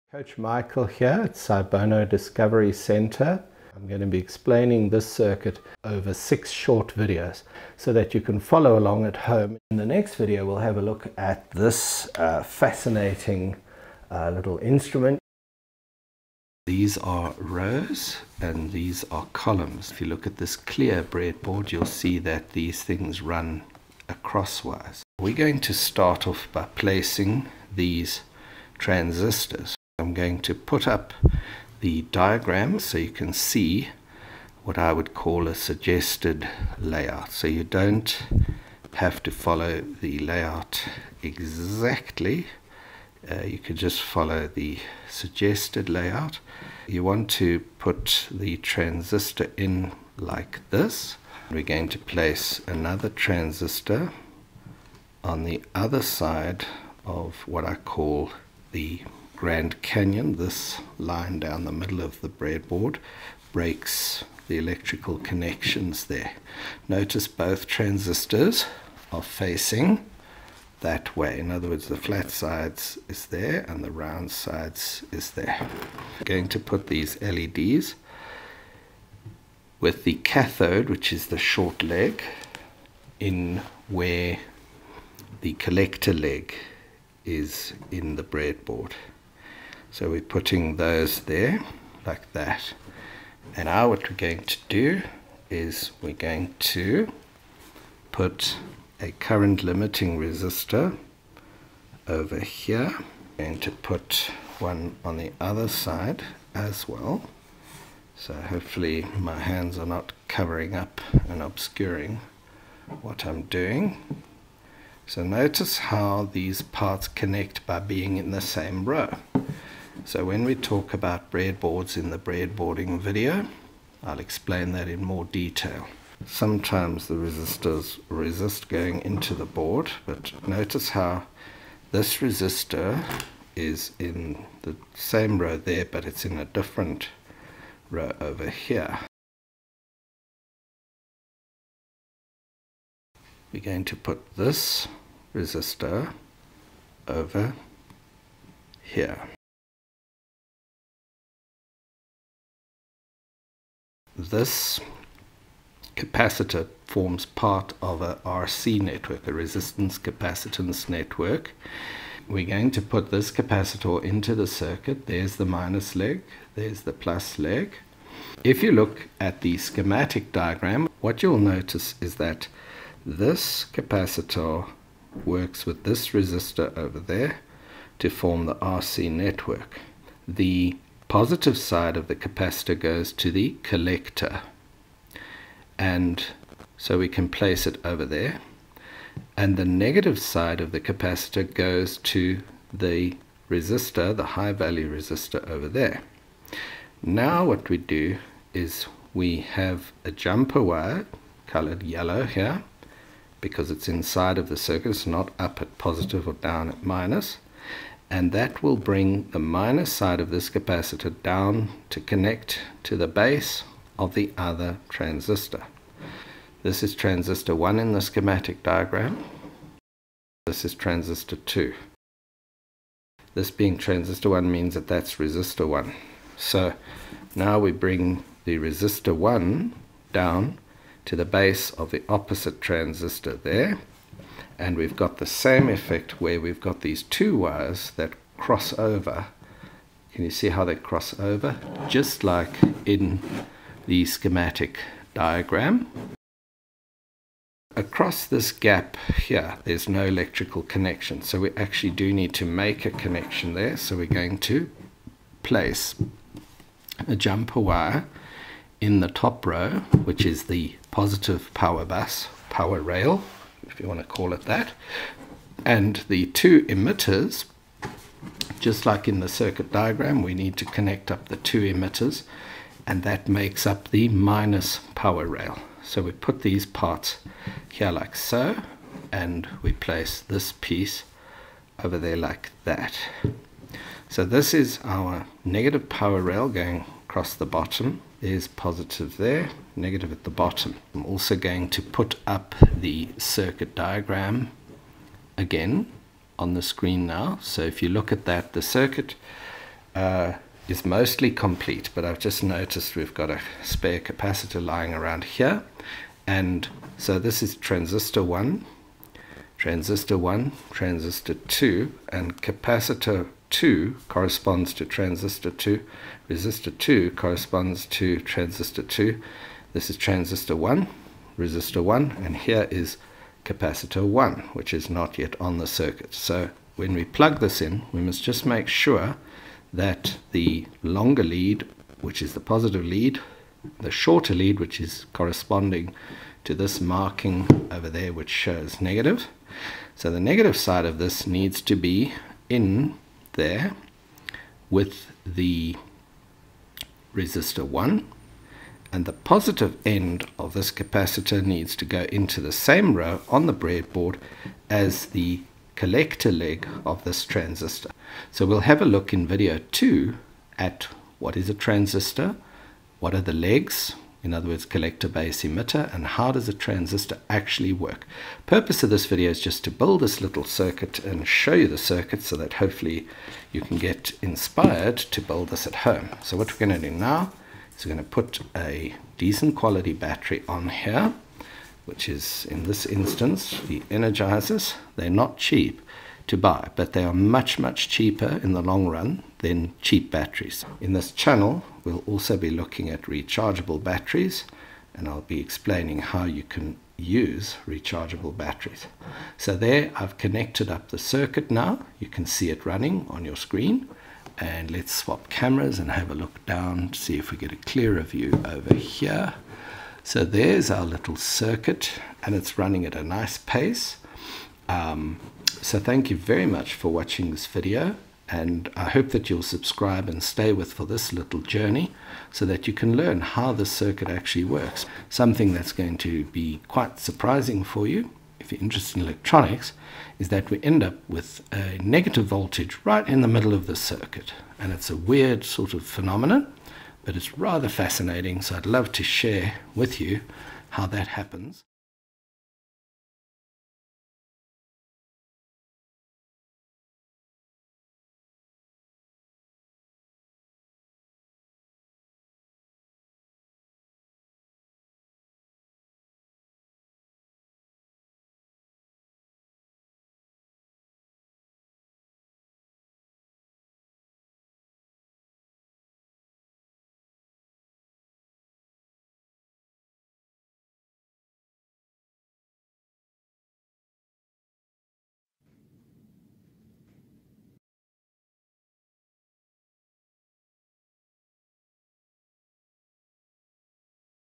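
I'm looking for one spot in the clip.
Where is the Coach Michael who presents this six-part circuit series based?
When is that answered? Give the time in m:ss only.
0:01.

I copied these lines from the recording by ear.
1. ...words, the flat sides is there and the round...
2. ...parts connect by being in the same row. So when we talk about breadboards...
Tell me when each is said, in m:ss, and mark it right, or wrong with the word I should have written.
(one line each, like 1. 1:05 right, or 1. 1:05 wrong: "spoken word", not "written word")
1. 1:11 right
2. 1:56 right.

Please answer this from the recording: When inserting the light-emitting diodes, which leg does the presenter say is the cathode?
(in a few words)
The short leg.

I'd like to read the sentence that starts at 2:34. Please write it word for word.
This capacitor forms part of a RC network, a resistance capacitance network.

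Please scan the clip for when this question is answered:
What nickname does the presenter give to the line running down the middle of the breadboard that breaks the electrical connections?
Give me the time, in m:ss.
0:58.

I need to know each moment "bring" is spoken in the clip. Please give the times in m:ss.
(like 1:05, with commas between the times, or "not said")
3:28, 3:47.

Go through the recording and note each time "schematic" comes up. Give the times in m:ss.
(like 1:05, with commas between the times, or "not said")
2:49, 3:38, 4:04.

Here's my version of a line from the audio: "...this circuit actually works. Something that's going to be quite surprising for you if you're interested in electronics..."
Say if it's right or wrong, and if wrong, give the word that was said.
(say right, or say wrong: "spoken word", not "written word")
right.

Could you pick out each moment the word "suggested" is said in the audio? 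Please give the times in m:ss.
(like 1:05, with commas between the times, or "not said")
0:35, 0:45.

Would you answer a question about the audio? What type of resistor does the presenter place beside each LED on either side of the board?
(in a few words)
Current limiting resistor.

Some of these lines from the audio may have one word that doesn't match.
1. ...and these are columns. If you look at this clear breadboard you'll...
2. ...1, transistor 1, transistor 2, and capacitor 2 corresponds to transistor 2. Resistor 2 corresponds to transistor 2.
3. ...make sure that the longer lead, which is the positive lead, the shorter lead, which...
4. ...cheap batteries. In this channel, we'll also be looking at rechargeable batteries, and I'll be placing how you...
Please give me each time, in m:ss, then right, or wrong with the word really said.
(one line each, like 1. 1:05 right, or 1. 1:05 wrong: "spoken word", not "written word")
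1. 0:18 right
2. 5:08 right
3. 5:28 right
4. 6:29 wrong: "explaining", not "placing".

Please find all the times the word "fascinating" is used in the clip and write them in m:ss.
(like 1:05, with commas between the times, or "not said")
0:12, 7:17.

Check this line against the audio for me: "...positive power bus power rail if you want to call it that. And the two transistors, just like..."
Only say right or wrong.
wrong.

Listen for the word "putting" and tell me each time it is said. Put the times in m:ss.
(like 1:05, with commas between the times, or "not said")
1:30.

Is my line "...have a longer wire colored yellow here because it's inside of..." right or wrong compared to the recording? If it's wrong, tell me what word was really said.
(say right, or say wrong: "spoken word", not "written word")
wrong: "jumper", not "longer".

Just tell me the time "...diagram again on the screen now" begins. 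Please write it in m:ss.
4:53.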